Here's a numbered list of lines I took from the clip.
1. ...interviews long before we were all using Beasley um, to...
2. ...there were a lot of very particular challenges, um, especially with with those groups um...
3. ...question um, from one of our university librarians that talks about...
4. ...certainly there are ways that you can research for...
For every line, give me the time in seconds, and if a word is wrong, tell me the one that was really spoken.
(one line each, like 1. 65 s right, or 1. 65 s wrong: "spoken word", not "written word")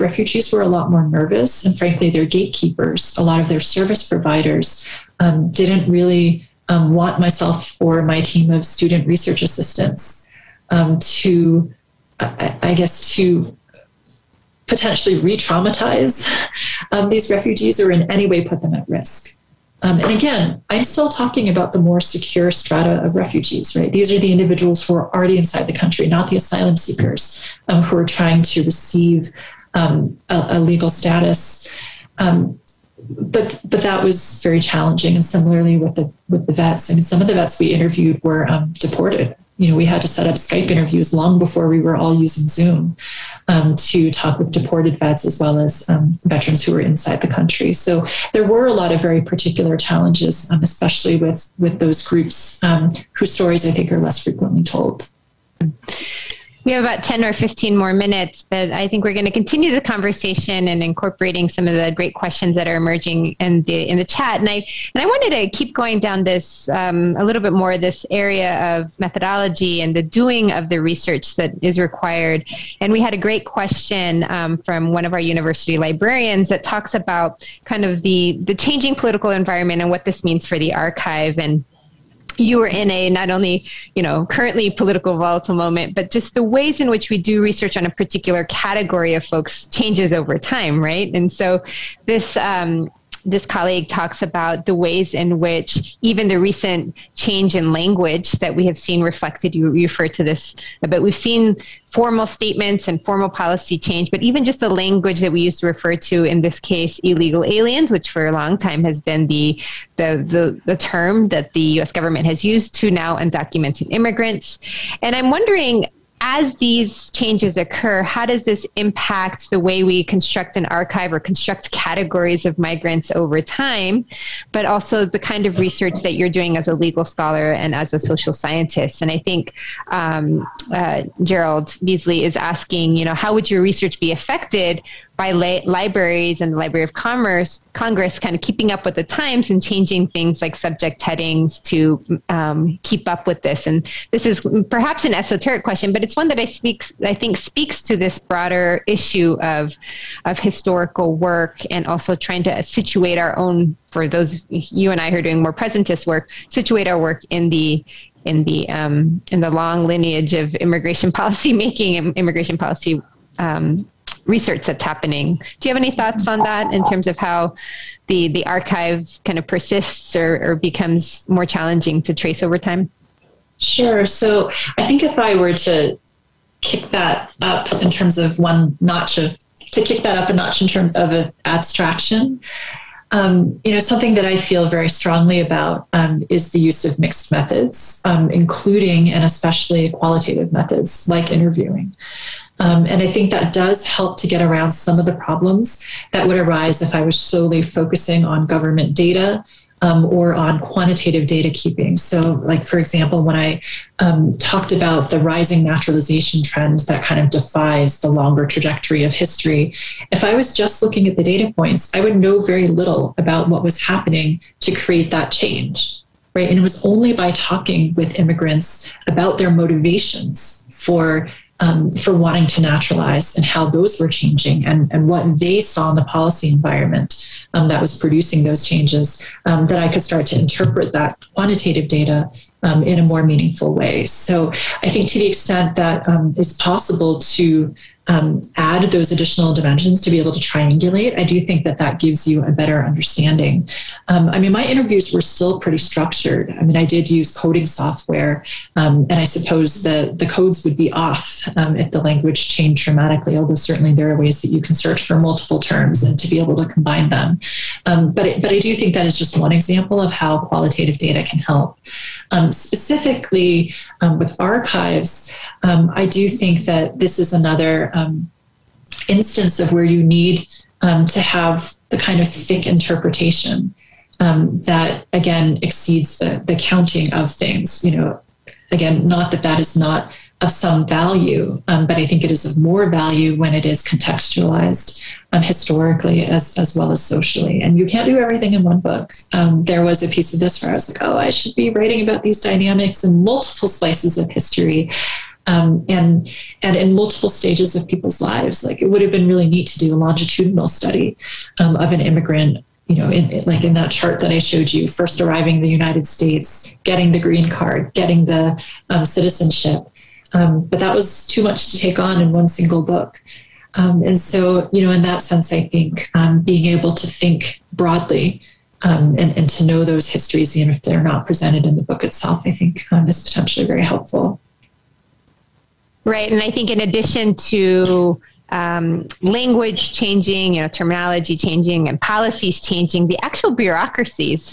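1. 40 s wrong: "Zoom", not "Beasley"
2. 48 s right
3. 73 s right
4. 253 s wrong: "search", not "research".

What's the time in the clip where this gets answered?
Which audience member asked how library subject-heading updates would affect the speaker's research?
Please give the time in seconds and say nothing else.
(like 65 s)
131 s.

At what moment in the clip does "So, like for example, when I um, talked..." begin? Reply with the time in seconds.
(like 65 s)
201 s.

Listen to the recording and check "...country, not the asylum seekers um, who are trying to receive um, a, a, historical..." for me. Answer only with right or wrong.
wrong.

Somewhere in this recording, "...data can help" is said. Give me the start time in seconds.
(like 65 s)
260 s.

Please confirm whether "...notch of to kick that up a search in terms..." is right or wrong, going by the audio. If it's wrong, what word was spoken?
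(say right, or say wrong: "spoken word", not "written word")
wrong: "notch", not "search".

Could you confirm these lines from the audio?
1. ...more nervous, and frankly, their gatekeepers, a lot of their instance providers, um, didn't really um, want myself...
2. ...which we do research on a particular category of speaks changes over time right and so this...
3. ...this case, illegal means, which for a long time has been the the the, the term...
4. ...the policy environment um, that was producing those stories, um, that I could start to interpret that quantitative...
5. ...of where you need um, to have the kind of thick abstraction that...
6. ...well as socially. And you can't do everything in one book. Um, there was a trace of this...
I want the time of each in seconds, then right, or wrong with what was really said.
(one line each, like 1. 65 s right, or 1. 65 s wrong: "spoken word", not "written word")
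1. 0 s wrong: "service", not "instance"
2. 86 s wrong: "folks", not "speaks"
3. 106 s wrong: "aliens", not "means"
4. 225 s wrong: "changes", not "stories"
5. 269 s wrong: "interpretation", not "abstraction"
6. 286 s wrong: "piece", not "trace".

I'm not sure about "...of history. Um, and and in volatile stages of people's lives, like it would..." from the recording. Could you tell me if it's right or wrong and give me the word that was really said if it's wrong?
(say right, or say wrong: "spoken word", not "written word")
wrong: "multiple", not "volatile".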